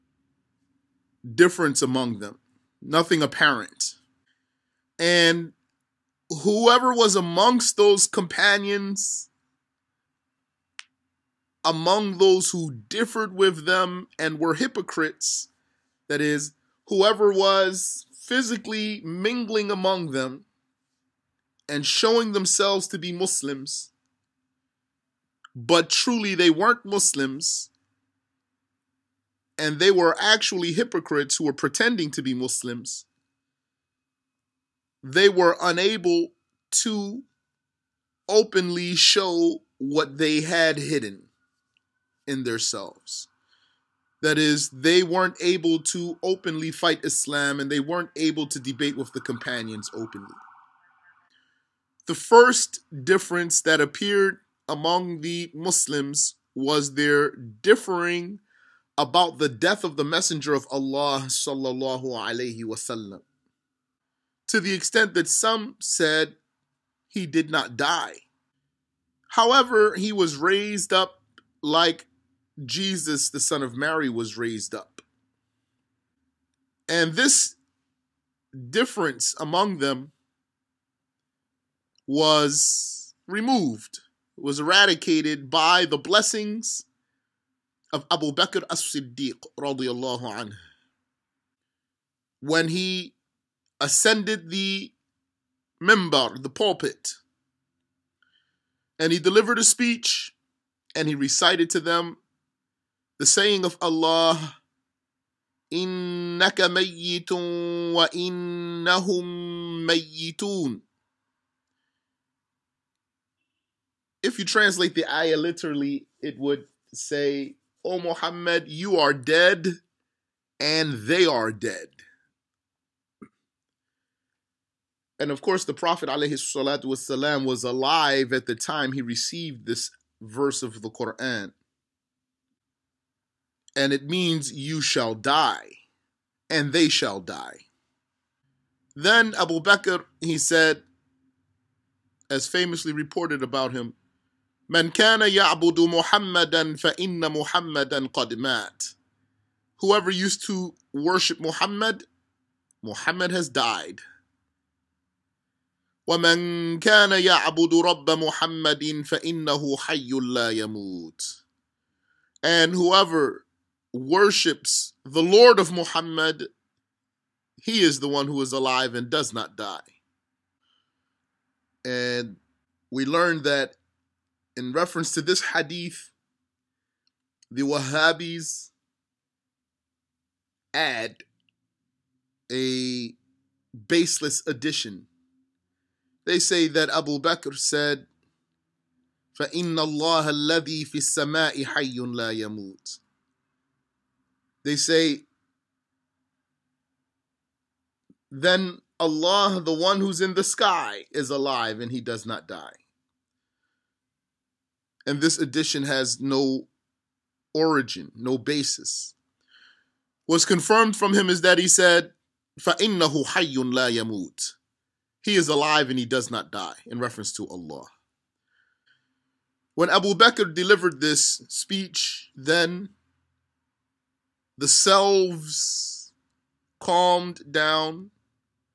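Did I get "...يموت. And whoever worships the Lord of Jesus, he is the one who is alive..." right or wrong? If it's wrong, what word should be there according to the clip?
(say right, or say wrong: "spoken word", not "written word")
wrong: "Muhammad", not "Jesus".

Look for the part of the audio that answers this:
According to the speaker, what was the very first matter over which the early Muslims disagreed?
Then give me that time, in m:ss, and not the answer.
0:59.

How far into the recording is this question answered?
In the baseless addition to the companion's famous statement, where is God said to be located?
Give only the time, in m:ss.
3:20.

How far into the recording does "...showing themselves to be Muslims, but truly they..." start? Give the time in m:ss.
0:21.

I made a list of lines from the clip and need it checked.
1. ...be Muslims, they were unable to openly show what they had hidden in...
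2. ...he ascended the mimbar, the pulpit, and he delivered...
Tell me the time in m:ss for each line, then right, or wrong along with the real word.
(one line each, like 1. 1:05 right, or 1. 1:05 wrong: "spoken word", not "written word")
1. 0:32 right
2. 1:32 right.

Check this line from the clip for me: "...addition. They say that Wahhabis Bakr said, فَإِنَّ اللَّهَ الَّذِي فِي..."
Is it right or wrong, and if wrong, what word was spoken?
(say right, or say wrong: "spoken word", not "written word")
wrong: "Abu", not "Wahhabis".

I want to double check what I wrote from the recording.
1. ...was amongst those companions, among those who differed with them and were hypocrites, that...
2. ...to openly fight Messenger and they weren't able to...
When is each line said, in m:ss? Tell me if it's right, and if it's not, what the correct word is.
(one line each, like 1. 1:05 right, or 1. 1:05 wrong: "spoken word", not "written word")
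1. 0:06 right
2. 0:45 wrong: "Islam", not "Messenger".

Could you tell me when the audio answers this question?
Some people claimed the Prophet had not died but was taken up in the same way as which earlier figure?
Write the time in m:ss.
1:12.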